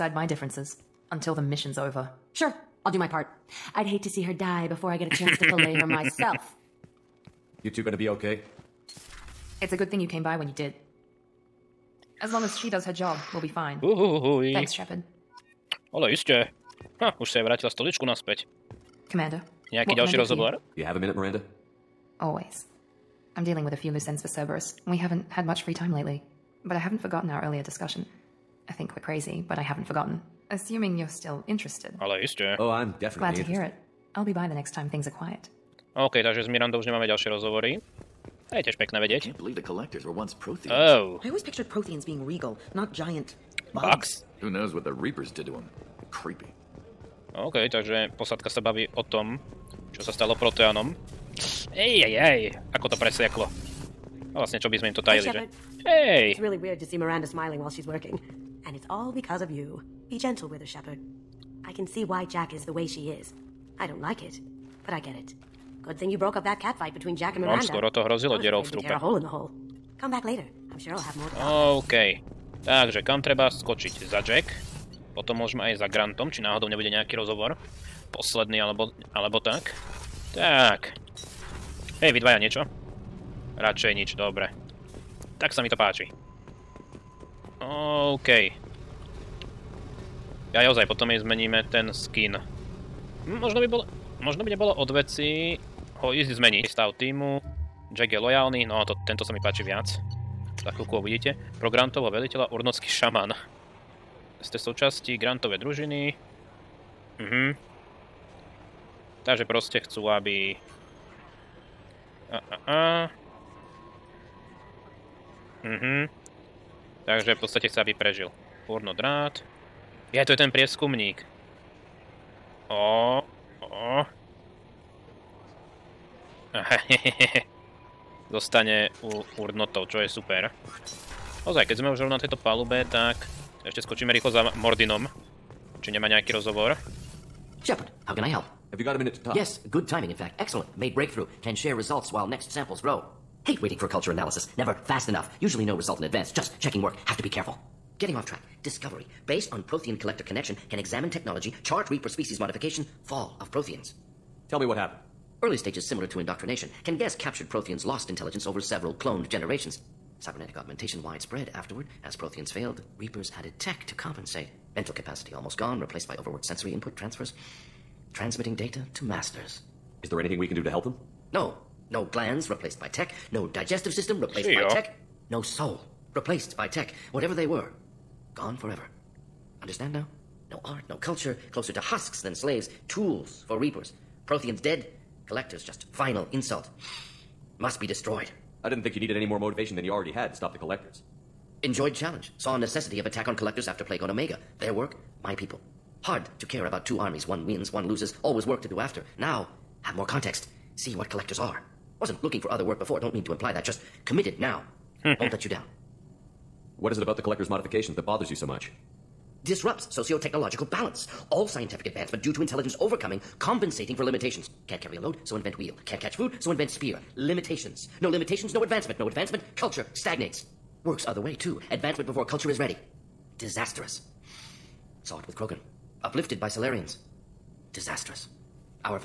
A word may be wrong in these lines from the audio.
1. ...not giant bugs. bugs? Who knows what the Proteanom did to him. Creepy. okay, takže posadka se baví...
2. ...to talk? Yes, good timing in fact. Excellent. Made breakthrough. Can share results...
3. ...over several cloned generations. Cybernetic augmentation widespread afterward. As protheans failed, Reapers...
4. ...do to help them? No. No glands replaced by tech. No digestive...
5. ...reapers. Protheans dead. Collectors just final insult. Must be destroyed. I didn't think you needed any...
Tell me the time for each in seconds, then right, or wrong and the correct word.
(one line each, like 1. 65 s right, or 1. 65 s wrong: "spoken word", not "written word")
1. 42 s wrong: "Reapers", not "Proteanom"
2. 139 s right
3. 158 s right
4. 170 s right
5. 183 s right.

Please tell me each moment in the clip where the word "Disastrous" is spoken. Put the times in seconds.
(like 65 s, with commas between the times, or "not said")
223 s, 227 s.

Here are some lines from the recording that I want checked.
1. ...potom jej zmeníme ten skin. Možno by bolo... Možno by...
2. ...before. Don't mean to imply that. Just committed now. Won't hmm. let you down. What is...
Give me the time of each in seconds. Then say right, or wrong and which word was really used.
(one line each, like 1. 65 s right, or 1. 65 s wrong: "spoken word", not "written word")
1. 90 s right
2. 202 s right.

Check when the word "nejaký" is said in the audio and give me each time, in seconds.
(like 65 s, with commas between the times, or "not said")
19 s, 76 s, 136 s.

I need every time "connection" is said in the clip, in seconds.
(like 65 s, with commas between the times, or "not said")
150 s.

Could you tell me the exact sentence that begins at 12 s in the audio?
As long as she does her job, we'll be fine.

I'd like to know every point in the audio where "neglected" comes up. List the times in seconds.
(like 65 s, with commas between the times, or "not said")
not said.